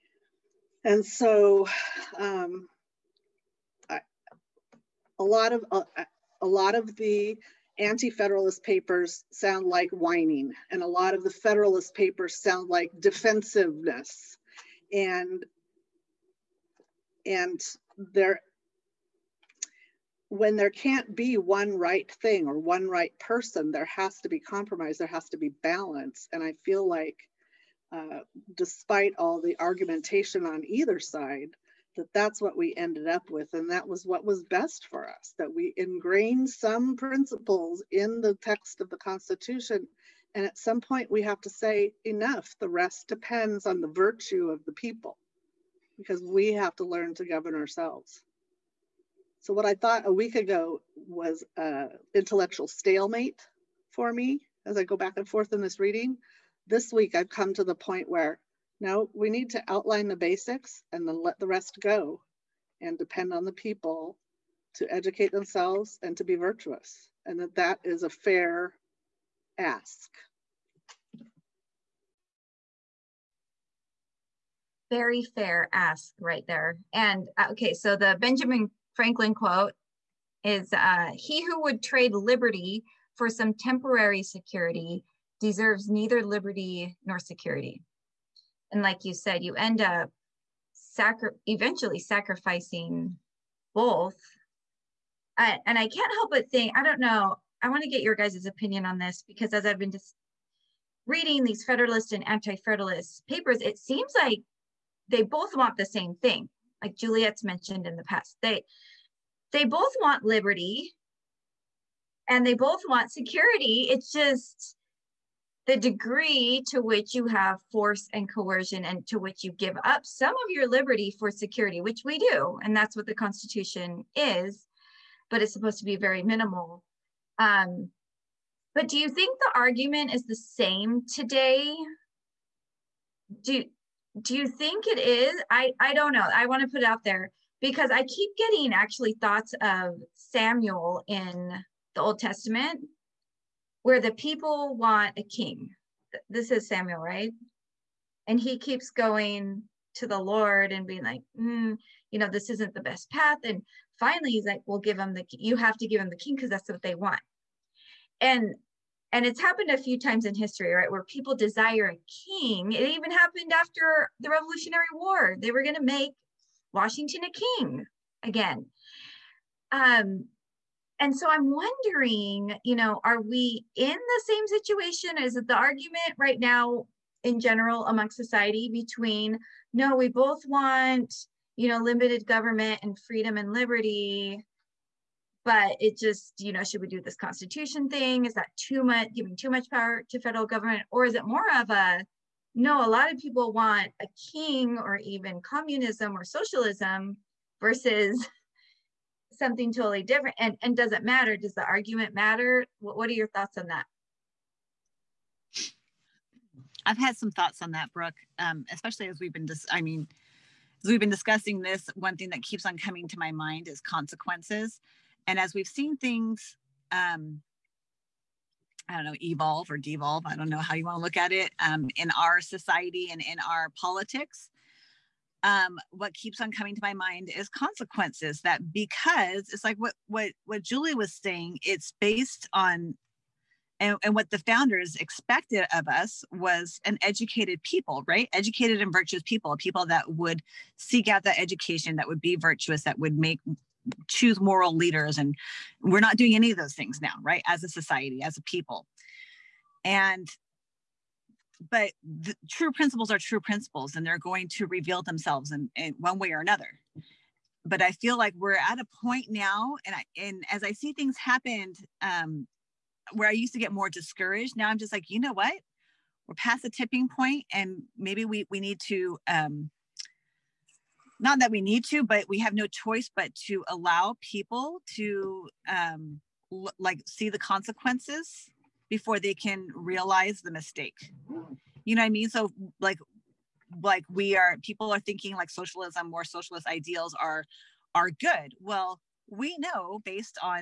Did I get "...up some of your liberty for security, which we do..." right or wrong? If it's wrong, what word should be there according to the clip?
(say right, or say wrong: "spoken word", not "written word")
right.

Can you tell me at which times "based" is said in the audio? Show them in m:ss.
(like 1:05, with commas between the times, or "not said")
3:51, 4:50.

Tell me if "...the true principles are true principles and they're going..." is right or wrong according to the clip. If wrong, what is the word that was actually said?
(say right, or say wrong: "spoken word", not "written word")
right.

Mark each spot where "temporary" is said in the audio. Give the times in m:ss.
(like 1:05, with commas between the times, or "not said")
1:23.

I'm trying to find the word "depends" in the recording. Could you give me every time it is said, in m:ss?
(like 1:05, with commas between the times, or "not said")
0:43, 1:02.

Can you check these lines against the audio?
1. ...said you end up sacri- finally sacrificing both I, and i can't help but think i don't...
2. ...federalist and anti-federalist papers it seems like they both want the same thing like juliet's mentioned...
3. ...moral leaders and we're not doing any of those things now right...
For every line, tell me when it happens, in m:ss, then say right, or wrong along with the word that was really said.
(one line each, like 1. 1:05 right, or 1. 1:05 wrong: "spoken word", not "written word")
1. 1:29 wrong: "eventually", not "finally"
2. 1:41 right
3. 4:04 right.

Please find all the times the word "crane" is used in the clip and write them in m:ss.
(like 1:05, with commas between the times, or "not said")
not said.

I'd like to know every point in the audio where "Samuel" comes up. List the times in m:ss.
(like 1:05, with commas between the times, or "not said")
2:20, 2:26.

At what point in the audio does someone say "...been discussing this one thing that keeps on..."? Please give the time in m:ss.
3:30.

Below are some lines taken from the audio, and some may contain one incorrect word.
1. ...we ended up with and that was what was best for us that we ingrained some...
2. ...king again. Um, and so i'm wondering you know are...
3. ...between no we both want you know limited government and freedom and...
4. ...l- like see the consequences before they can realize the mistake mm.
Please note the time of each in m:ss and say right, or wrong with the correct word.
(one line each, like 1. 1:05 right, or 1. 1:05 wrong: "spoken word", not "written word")
1. 0:32 right
2. 2:47 right
3. 2:58 right
4. 4:36 right.